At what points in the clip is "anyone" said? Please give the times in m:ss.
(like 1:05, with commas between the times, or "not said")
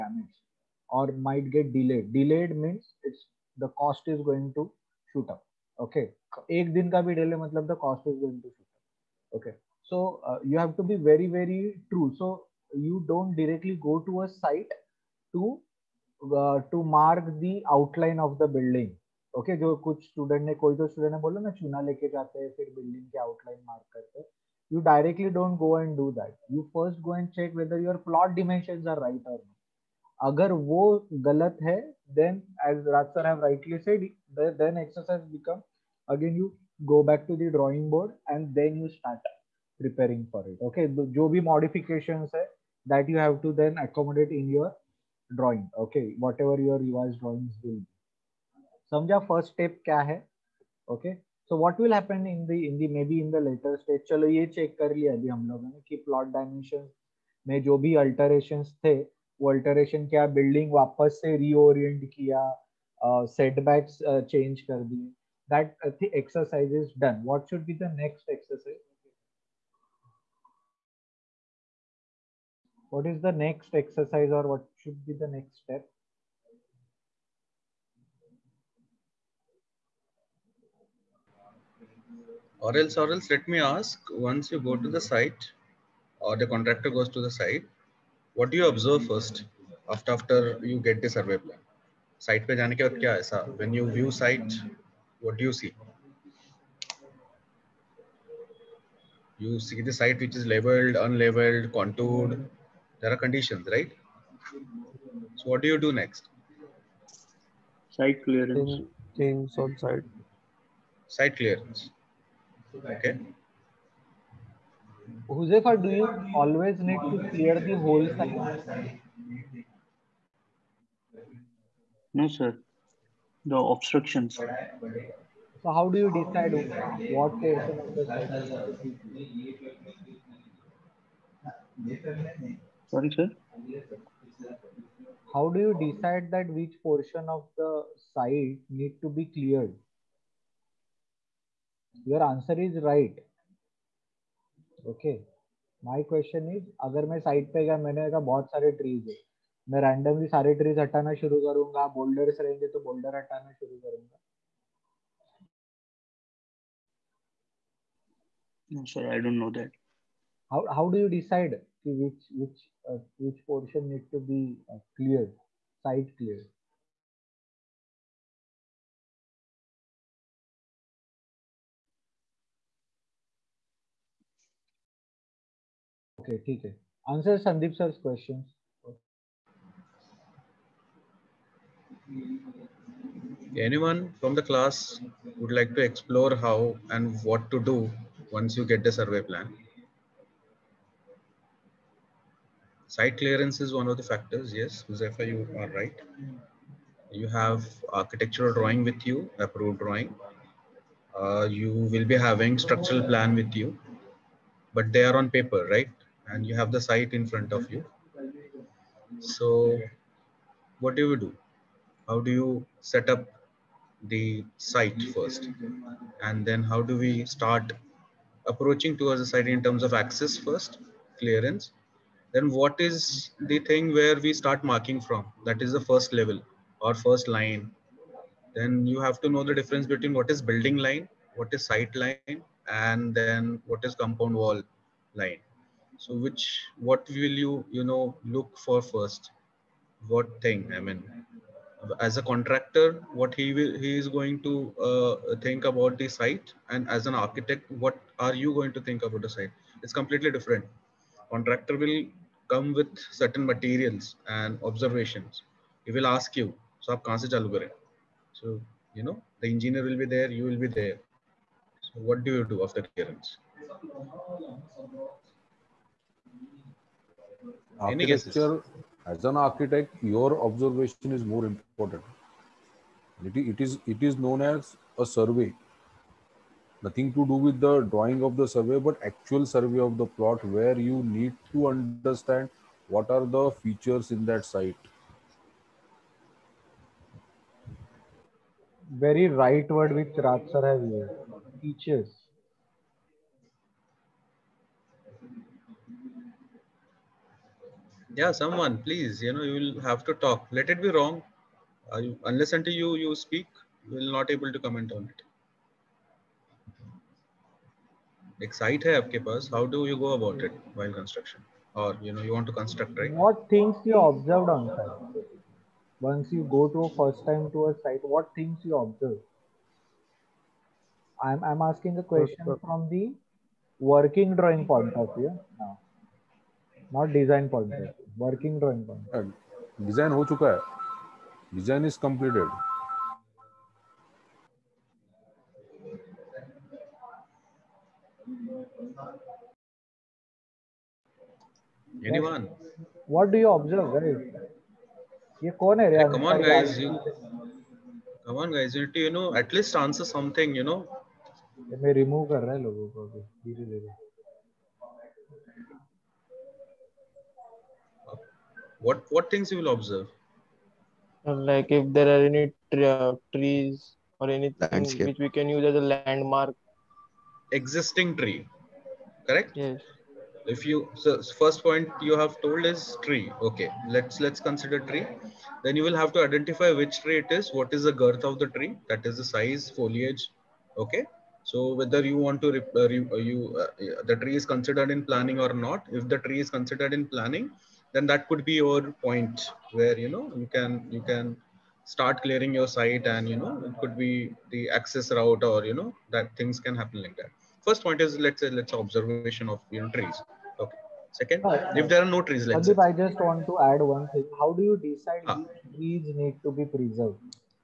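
3:03, 5:42.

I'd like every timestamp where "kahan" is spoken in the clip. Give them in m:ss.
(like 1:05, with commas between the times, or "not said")
4:17.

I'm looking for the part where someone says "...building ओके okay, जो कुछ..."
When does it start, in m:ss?
0:18.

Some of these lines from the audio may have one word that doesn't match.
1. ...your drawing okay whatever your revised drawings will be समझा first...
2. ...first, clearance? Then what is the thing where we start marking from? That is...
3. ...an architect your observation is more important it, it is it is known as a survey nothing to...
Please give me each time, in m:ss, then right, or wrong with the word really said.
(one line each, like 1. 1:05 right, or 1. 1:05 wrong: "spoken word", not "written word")
1. 0:44 right
2. 3:40 right
3. 4:29 right.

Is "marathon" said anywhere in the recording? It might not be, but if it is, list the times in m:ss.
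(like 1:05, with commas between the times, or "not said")
not said.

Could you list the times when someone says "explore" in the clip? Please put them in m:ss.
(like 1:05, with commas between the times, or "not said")
3:05.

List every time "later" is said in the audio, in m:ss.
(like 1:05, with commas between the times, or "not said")
0:53.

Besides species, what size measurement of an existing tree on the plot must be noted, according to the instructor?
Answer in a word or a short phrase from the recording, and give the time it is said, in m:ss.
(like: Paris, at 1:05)
Girth, at 6:17.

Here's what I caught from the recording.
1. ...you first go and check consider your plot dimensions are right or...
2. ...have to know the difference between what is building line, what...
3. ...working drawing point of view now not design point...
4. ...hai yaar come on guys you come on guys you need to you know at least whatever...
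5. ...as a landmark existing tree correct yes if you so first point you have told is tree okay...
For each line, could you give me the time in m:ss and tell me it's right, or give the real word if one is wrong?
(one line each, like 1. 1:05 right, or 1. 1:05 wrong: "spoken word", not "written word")
1. 0:26 wrong: "whether", not "consider"
2. 3:48 right
3. 5:23 right
4. 5:45 wrong: "answer", not "whatever"
5. 6:05 right.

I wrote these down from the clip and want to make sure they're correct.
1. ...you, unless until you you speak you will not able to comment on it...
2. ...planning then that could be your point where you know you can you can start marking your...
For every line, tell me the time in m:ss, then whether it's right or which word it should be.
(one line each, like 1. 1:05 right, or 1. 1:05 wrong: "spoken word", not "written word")
1. 5:02 right
2. 6:27 wrong: "clearing", not "marking".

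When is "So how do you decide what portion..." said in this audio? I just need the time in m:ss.
2:04.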